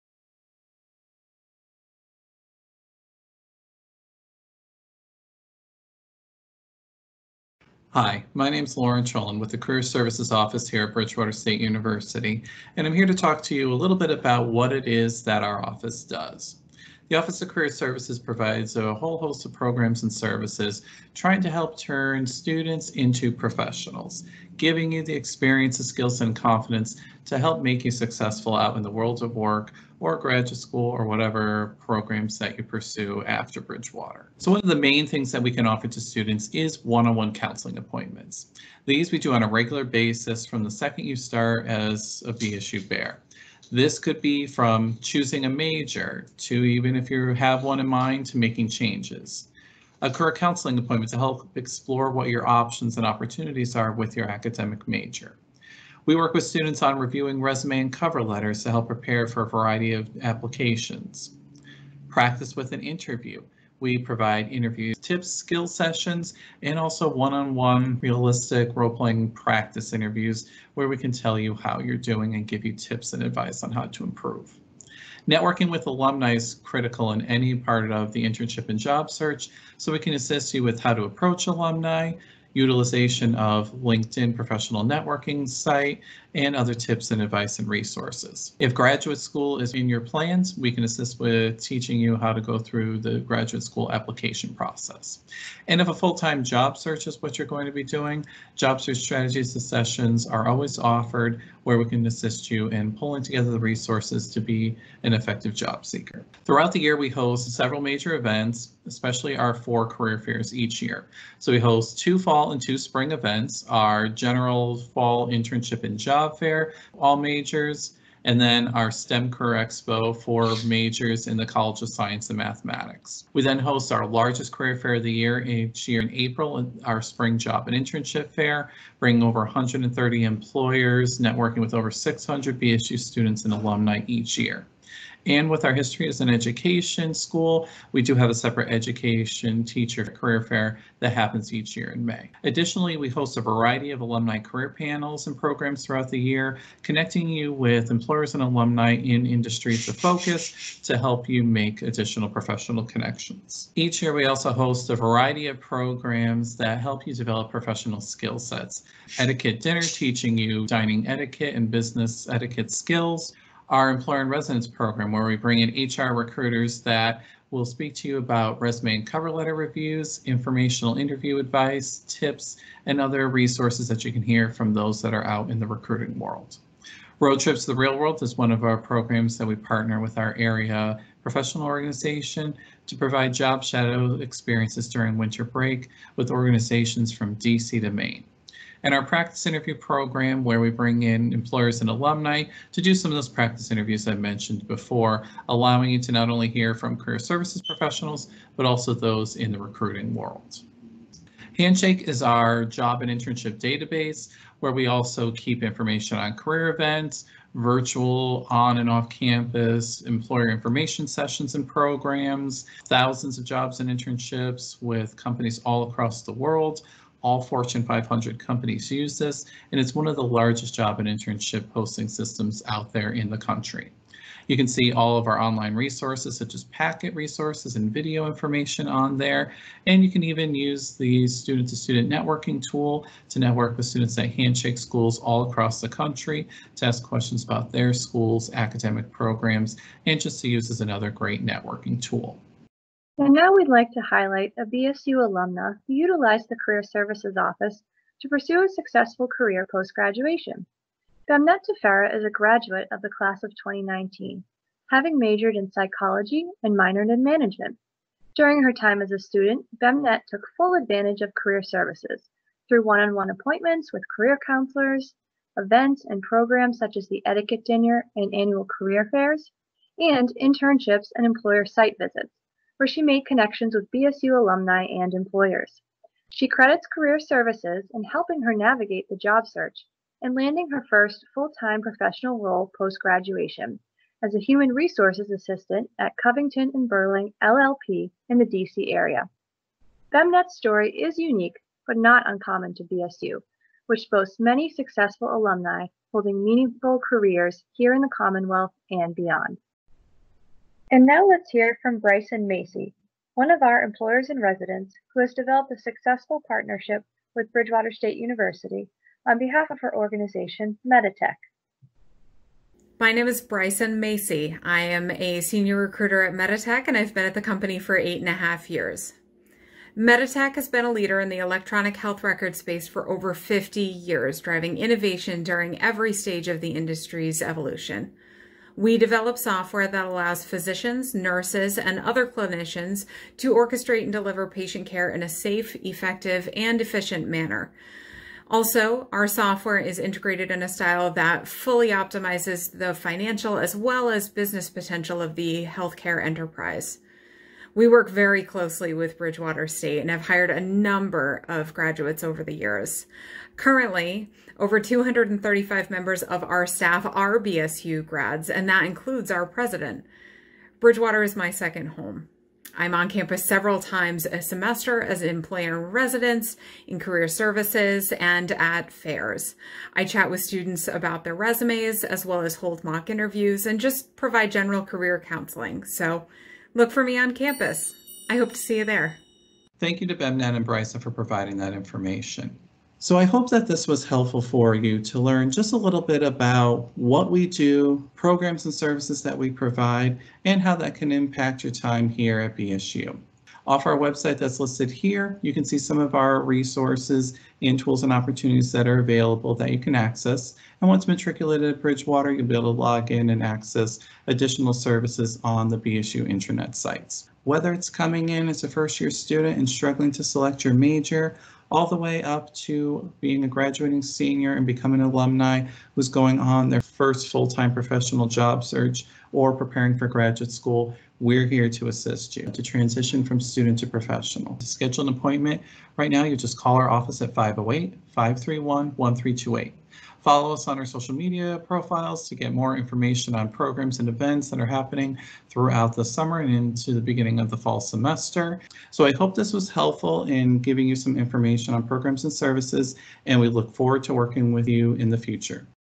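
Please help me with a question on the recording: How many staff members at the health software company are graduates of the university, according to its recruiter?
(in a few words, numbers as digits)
over 235.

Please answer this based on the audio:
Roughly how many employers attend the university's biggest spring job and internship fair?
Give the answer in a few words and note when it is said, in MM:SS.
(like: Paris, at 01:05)
130, at 02:09.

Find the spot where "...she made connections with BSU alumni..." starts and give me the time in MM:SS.
04:32.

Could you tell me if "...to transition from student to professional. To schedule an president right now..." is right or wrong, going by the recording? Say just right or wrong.
wrong.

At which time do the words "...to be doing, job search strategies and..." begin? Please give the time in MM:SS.
01:37.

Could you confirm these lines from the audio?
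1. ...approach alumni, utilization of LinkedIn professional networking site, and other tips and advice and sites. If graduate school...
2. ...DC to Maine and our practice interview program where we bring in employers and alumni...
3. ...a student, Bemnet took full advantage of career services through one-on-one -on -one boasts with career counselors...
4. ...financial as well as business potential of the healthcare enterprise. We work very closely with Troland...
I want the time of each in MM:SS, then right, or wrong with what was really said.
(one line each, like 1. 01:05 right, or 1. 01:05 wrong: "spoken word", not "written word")
1. 01:21 wrong: "resources", not "sites"
2. 03:07 right
3. 04:19 wrong: "appointments", not "boasts"
4. 05:42 wrong: "Bridgewater", not "Troland".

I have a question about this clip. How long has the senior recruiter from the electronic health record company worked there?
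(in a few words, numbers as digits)
8 and a half years.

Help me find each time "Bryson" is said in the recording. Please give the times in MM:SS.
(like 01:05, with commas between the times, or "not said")
05:01, 05:13, 06:20.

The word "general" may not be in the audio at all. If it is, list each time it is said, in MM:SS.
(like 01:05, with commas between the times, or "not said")
01:54, 06:14.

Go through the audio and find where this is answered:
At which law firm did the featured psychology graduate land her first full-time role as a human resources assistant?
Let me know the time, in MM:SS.
04:46.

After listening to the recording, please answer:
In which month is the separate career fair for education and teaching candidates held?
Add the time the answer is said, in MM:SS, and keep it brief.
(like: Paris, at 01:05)
May, at 02:22.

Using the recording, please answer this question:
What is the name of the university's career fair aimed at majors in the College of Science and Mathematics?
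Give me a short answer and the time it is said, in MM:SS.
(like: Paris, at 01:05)
STEM Career Expo, at 01:58.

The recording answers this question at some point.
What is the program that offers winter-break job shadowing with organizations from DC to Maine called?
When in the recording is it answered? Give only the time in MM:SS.
02:57.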